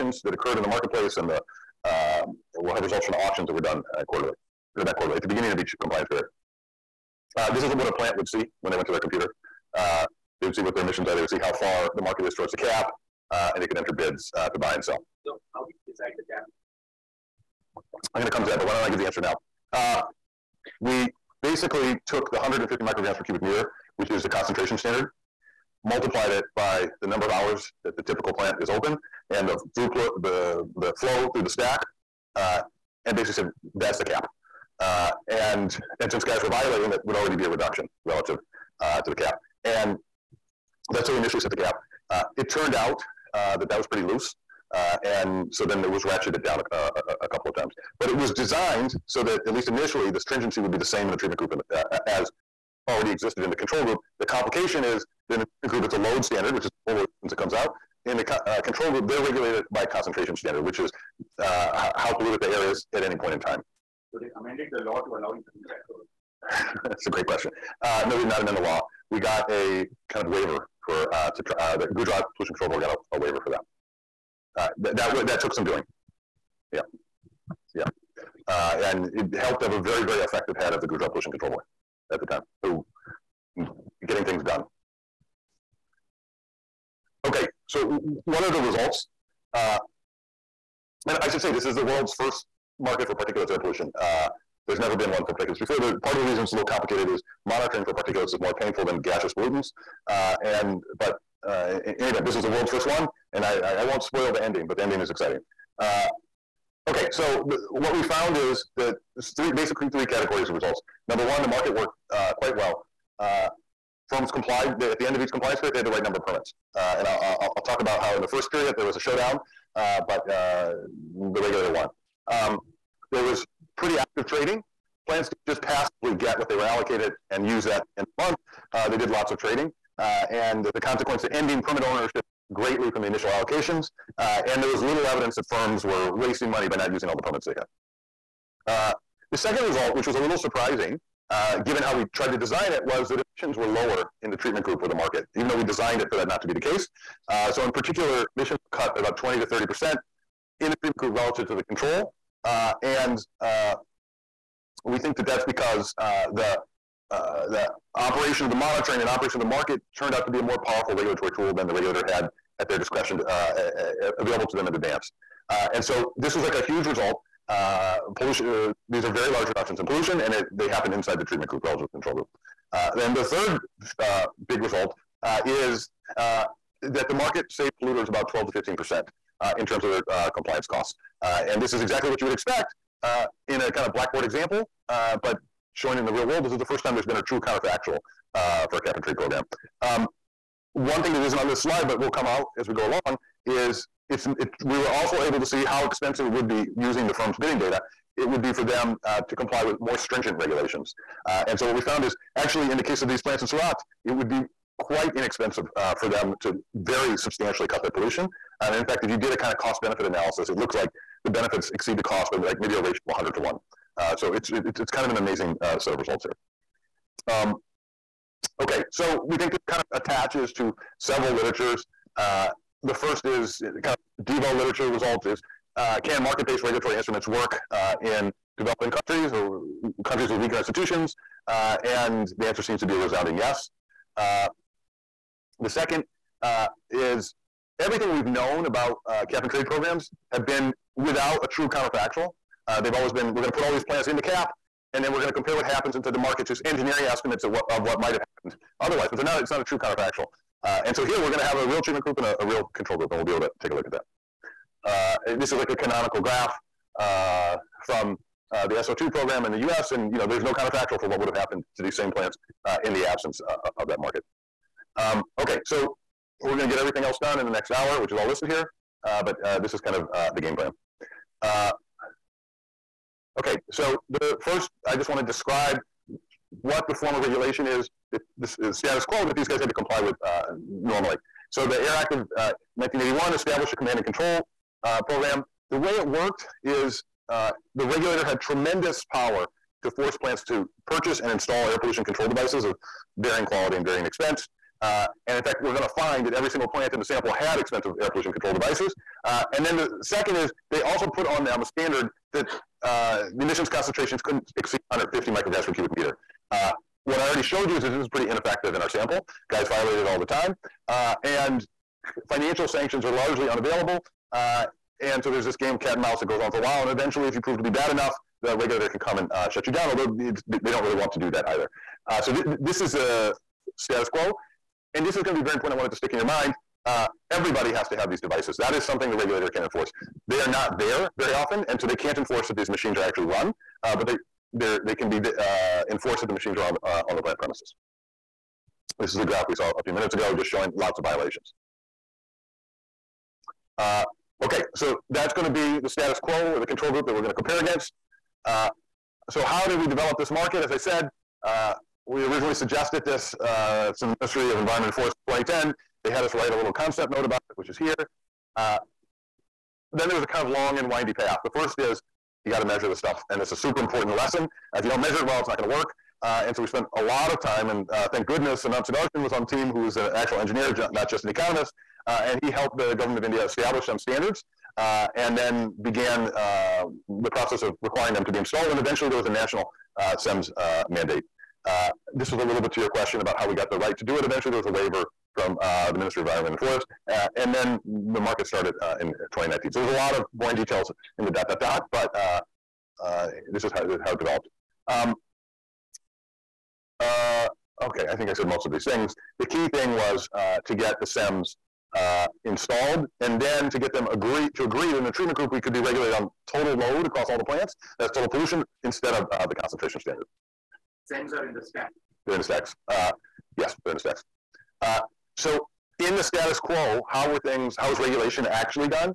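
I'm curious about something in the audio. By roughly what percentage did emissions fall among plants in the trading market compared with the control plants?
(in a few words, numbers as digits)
20 to 30 percent.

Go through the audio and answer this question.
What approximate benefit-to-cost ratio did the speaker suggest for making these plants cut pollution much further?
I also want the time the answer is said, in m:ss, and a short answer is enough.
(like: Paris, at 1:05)
100 to 1, at 3:33.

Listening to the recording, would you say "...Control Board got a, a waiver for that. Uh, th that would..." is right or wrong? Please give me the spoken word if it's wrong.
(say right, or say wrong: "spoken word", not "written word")
right.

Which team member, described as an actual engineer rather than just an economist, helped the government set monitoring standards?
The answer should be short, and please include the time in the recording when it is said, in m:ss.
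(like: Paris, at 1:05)
Anant Sudarshan, at 6:08.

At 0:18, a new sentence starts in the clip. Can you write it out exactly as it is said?
I'm going to come to that, but why don't I give the answer now?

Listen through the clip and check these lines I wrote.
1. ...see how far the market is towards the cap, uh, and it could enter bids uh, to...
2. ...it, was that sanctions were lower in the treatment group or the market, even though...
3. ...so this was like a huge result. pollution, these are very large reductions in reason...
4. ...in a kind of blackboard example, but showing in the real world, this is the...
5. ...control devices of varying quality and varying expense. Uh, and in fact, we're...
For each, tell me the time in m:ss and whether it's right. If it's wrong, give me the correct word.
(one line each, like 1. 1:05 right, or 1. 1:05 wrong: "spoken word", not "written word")
1. 0:11 right
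2. 2:22 wrong: "emissions", not "sanctions"
3. 2:45 wrong: "pollution", not "reason"
4. 3:03 right
5. 4:52 right.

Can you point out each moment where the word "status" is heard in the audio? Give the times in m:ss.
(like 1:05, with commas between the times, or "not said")
4:38, 5:23, 5:45, 6:56.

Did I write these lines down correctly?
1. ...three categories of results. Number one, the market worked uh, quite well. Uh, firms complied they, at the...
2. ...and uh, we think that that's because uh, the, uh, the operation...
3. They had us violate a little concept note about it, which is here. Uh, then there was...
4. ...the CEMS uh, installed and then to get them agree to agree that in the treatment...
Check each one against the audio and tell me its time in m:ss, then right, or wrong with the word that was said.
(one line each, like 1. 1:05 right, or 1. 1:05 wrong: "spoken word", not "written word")
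1. 1:49 right
2. 2:32 right
3. 5:56 wrong: "write", not "violate"
4. 6:41 right.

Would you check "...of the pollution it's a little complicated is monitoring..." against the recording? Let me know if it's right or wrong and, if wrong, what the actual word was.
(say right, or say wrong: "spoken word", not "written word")
wrong: "reason", not "pollution".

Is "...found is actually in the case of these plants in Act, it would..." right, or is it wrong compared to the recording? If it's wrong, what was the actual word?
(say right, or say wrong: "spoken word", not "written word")
wrong: "Surat", not "Act".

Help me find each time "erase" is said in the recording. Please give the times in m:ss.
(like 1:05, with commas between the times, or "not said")
not said.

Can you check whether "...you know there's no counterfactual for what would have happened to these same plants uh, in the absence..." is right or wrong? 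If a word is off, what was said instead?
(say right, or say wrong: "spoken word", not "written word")
right.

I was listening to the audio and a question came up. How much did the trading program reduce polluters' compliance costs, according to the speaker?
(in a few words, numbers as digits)
12 to 15 percent.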